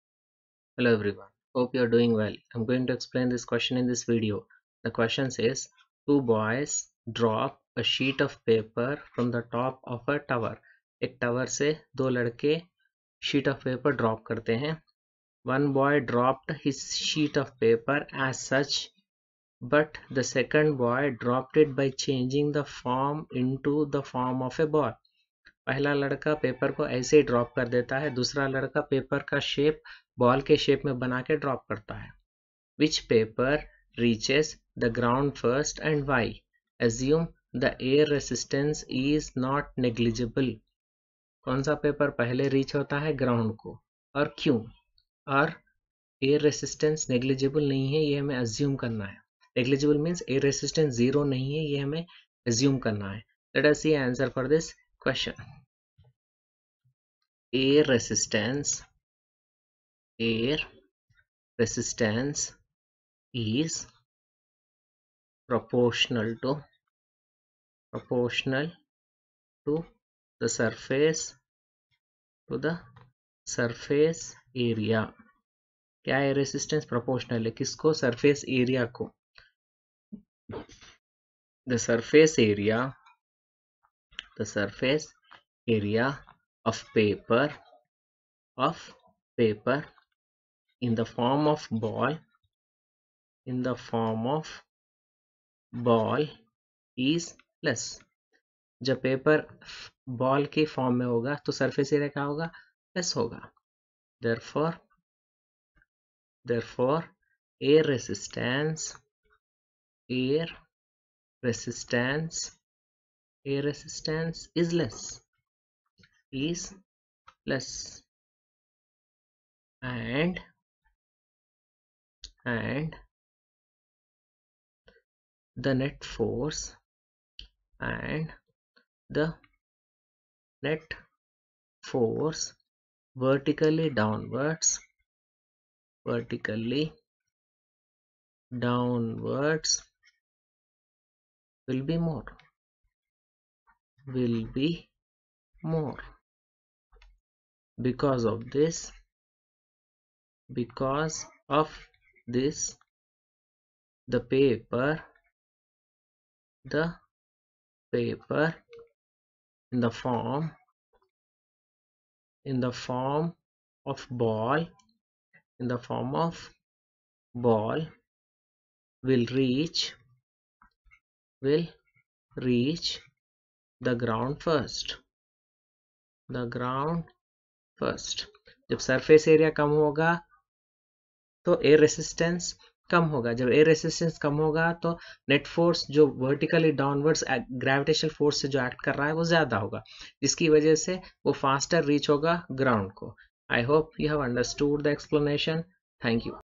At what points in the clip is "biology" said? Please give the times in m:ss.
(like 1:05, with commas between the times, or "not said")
not said.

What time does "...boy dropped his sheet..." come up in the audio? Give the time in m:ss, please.
0:15.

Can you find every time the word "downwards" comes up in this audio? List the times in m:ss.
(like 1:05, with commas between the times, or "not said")
2:13, 2:18.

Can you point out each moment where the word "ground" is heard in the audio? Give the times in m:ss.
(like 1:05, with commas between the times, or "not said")
2:54.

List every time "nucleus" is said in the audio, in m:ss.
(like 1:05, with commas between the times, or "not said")
not said.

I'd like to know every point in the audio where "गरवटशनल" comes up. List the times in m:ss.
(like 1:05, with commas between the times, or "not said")
3:07.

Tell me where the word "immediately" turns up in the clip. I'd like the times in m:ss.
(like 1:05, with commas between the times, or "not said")
not said.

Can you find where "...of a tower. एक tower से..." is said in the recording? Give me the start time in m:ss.
0:09.